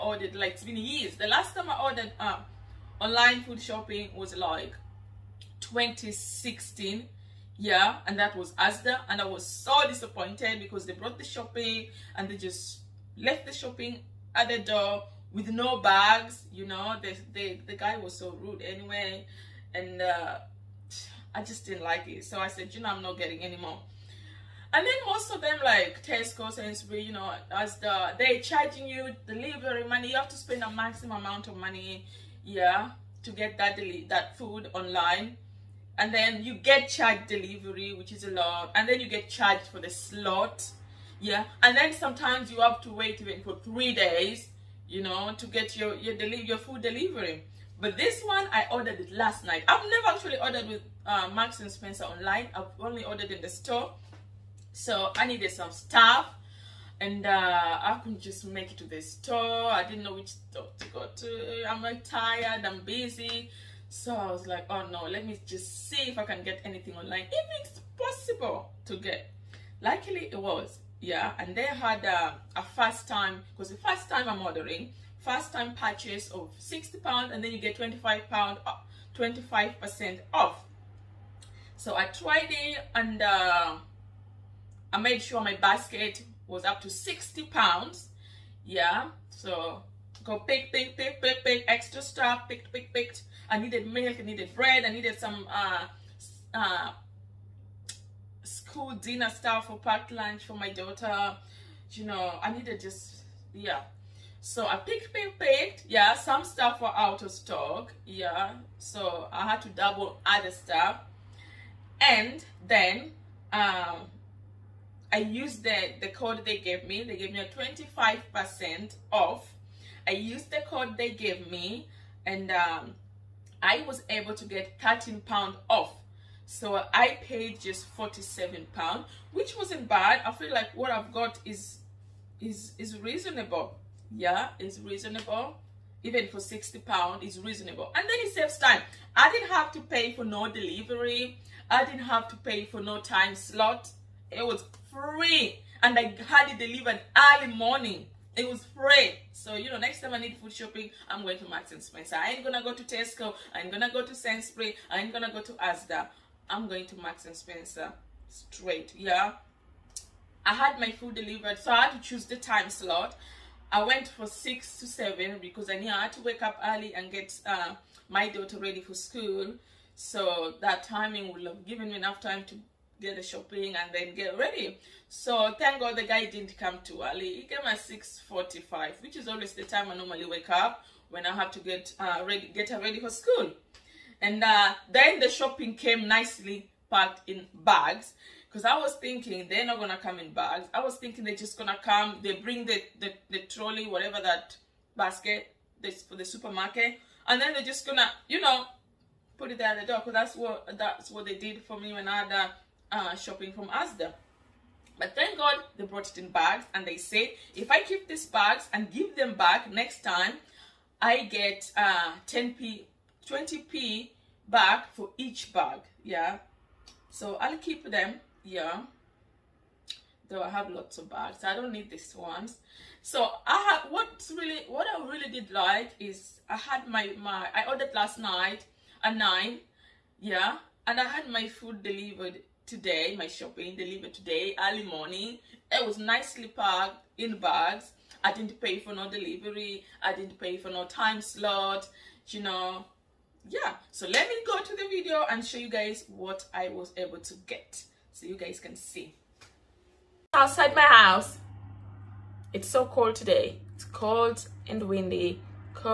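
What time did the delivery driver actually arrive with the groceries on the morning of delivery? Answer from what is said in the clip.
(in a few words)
6:45.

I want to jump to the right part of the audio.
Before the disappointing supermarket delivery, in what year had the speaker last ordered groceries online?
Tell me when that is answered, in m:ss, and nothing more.
0:05.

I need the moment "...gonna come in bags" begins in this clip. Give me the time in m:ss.
3:09.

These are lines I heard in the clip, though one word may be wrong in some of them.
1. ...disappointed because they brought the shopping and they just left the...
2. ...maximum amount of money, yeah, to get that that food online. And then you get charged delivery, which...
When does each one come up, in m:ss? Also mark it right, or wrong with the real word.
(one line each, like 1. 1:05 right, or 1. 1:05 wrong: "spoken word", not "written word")
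1. 0:09 right
2. 0:30 right.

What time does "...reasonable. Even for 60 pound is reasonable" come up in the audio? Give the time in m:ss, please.
2:14.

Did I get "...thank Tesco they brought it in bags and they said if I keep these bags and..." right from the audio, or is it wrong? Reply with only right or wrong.
wrong.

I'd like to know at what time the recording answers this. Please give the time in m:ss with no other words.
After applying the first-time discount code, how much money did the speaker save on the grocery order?
2:04.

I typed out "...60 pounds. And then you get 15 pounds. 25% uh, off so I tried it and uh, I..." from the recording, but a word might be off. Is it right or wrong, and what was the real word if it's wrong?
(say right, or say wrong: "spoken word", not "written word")
wrong: "25", not "15".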